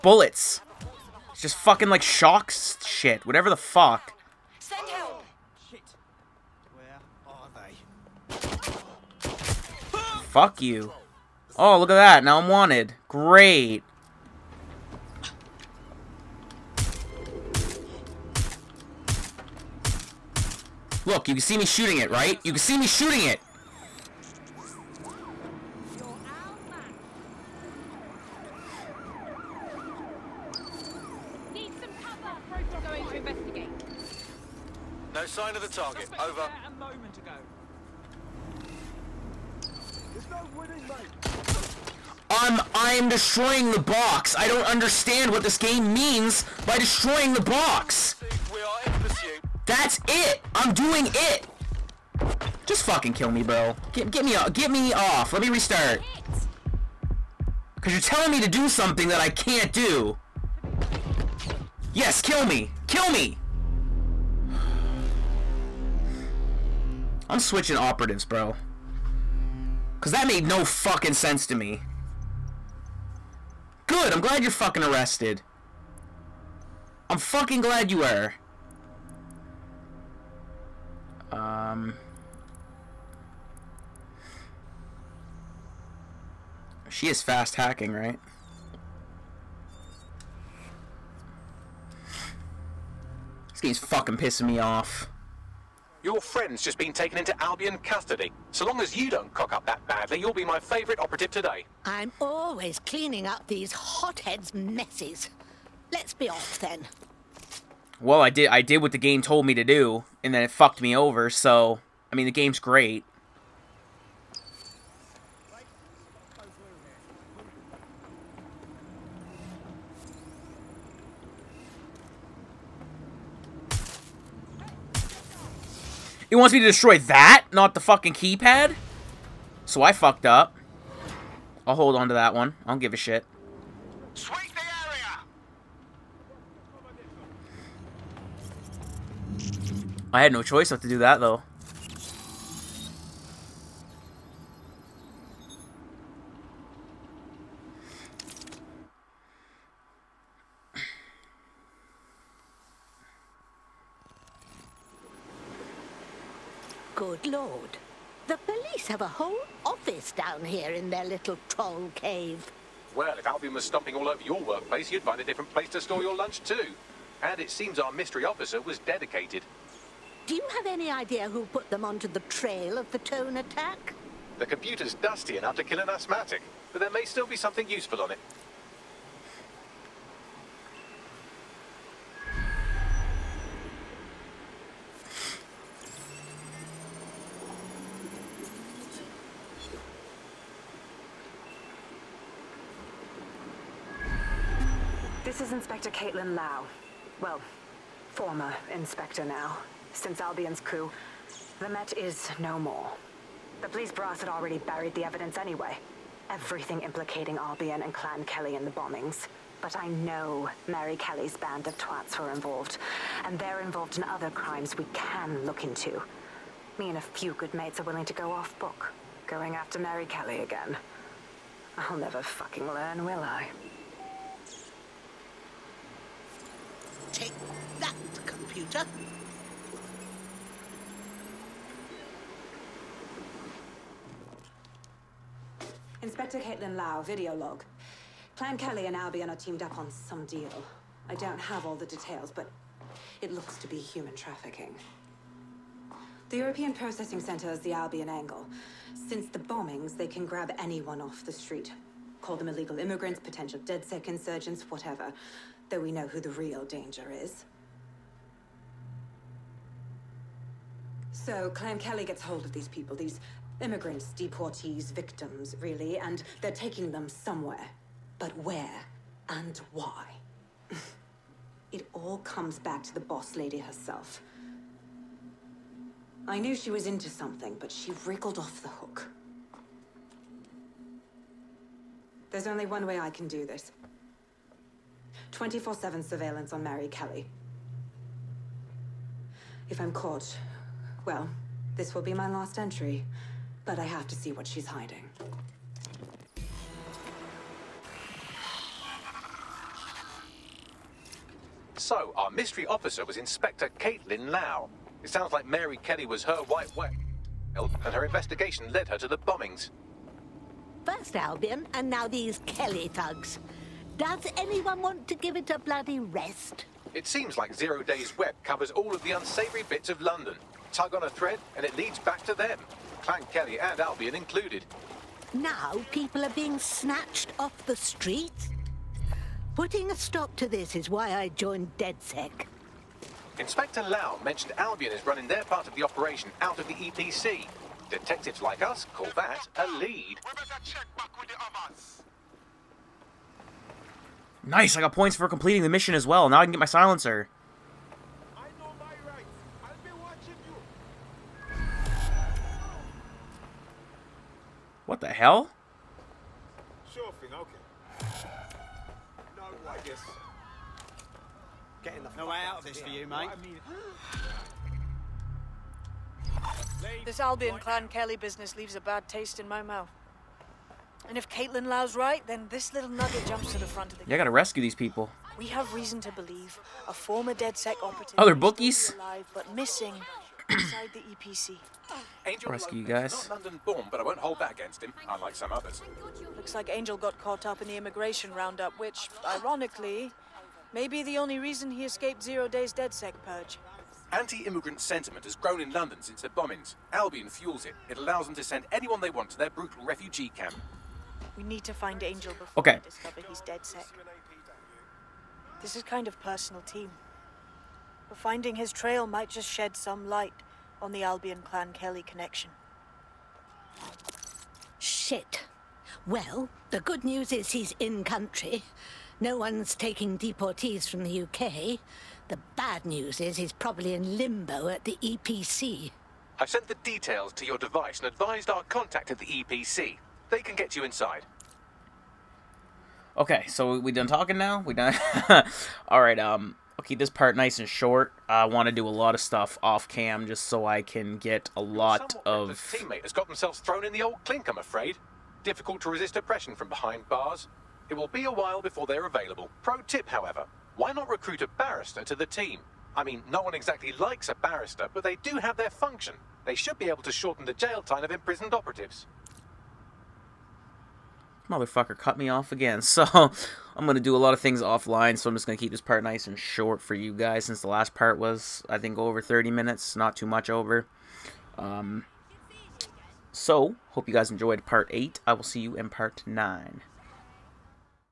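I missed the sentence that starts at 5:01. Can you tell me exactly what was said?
So, our mystery officer was Inspector Caitlin Lau.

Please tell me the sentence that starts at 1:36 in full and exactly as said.
Your friend's just been taken into Albion custody.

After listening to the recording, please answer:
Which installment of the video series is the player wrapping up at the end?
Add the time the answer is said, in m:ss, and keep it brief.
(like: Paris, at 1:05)
Part 8, at 7:54.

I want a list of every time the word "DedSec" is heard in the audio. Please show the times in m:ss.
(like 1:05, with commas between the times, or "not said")
4:13, 5:31, 6:17, 6:32, 6:43.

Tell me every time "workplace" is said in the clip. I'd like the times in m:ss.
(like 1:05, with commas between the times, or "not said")
2:44.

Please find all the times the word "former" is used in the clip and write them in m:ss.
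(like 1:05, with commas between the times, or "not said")
3:18, 6:16.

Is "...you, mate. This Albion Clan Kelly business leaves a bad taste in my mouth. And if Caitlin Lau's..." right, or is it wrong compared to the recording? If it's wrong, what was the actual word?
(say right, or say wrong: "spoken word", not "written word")
right.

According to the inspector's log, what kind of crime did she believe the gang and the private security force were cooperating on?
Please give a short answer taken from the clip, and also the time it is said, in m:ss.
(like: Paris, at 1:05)
Human trafficking, at 4:03.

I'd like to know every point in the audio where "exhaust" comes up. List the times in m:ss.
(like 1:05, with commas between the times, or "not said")
not said.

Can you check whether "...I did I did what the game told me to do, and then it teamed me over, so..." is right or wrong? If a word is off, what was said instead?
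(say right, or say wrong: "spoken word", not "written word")
wrong: "fucked", not "teamed".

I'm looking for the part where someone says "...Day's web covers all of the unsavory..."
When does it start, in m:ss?
5:17.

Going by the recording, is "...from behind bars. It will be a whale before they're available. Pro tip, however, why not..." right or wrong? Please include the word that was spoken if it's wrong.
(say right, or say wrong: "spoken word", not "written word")
wrong: "while", not "whale".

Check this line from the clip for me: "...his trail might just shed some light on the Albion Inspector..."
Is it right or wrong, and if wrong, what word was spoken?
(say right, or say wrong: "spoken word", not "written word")
wrong: "Clan", not "Inspector".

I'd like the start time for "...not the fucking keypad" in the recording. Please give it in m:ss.
2:07.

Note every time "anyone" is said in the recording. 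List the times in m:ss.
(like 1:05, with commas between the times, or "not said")
4:10, 5:14, 6:38.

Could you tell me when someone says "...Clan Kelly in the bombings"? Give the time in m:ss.
3:27.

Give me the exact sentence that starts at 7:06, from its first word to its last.
I sent the details to your device and advised our contact at the EPC.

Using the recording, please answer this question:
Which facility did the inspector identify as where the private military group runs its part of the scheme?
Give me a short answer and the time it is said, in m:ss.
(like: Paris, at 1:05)
European Processing Center, at 4:06.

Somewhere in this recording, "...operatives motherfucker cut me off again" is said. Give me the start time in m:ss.
7:38.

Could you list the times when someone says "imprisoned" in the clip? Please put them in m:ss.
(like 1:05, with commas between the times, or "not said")
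7:38.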